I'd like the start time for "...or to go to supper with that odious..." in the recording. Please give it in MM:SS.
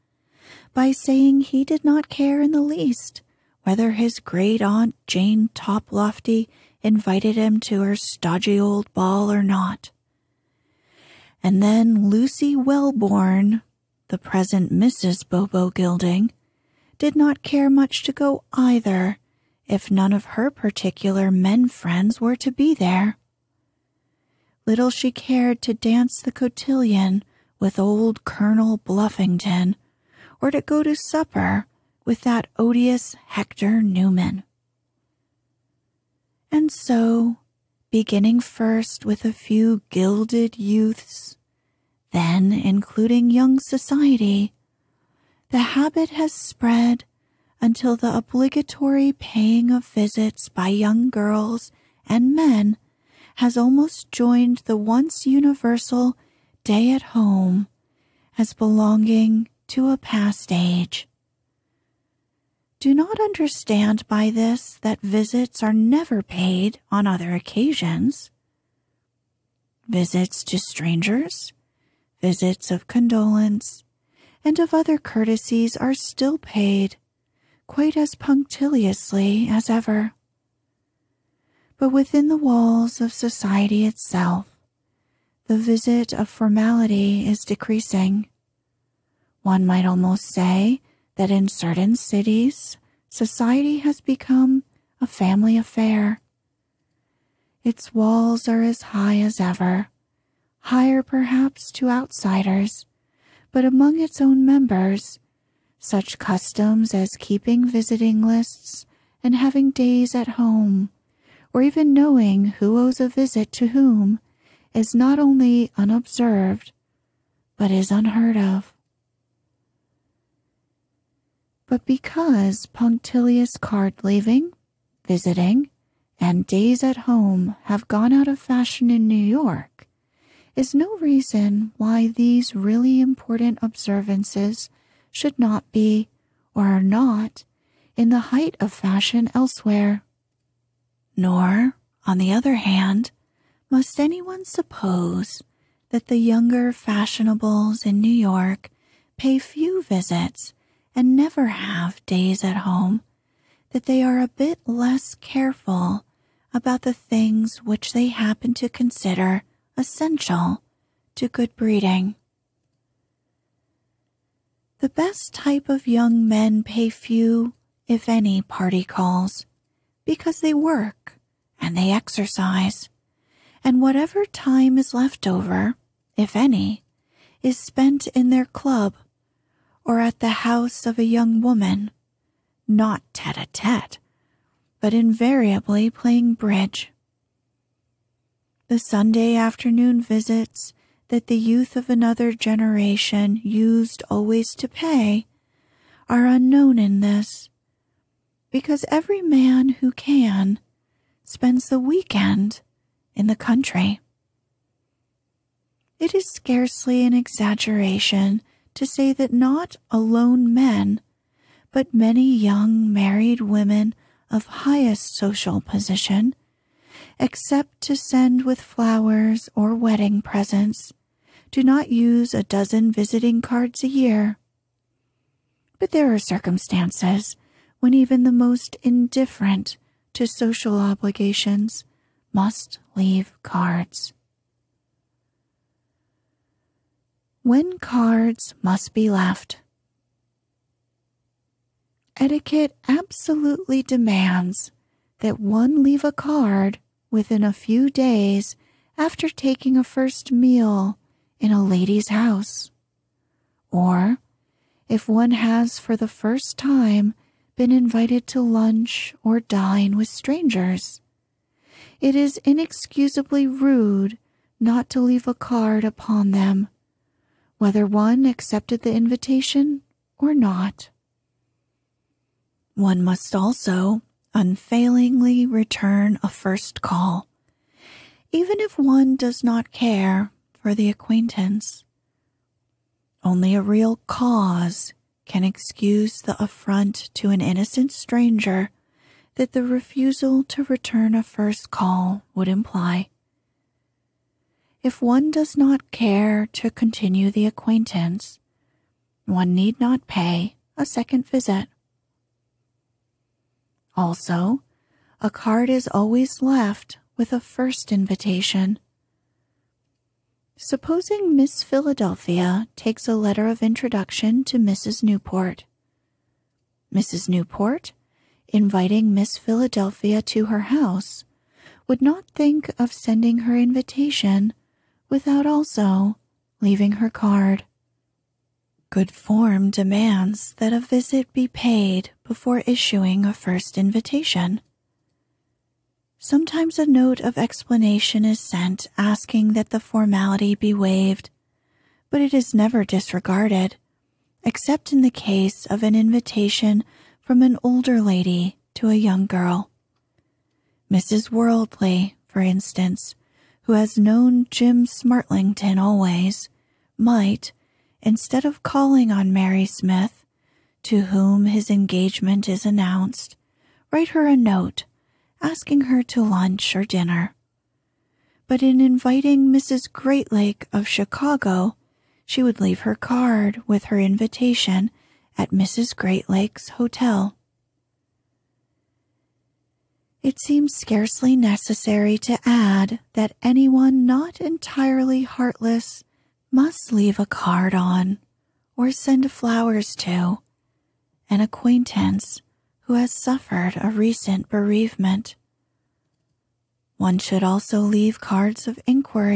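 00:30.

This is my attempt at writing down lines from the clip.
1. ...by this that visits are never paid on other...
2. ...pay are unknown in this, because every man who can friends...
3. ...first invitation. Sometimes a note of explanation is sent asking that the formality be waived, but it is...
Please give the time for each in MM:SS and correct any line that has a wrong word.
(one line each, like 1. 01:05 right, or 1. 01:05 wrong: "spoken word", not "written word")
1. 01:04 right
2. 03:14 wrong: "spends", not "friends"
3. 05:33 right.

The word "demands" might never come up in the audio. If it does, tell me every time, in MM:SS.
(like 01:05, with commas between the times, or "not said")
04:03, 05:29.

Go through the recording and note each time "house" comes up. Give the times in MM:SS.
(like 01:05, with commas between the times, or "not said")
03:00, 04:12, 05:20.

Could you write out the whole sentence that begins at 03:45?
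But there are circumstances when even the most indifferent to social obligations must leave cards.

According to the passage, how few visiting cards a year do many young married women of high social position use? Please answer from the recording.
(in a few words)
a dozen.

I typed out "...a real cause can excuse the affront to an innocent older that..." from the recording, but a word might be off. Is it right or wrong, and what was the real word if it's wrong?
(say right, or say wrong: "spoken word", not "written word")
wrong: "stranger", not "older".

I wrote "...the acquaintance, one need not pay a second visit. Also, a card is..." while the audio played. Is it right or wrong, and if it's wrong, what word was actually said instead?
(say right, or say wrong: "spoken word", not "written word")
right.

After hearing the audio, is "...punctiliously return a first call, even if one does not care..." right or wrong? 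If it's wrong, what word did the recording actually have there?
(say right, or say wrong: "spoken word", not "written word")
wrong: "unfailingly", not "punctiliously".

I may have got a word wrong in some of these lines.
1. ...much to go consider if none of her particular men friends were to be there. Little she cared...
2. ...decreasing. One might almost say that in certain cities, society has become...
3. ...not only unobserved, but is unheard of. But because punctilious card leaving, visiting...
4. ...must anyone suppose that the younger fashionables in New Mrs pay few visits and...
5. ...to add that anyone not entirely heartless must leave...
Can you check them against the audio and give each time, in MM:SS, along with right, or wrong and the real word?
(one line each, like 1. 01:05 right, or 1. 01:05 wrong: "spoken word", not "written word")
1. 00:17 wrong: "either", not "consider"
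2. 01:27 right
3. 01:54 right
4. 02:23 wrong: "York", not "Mrs"
5. 06:22 right.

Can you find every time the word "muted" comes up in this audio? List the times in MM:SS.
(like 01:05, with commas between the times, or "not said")
not said.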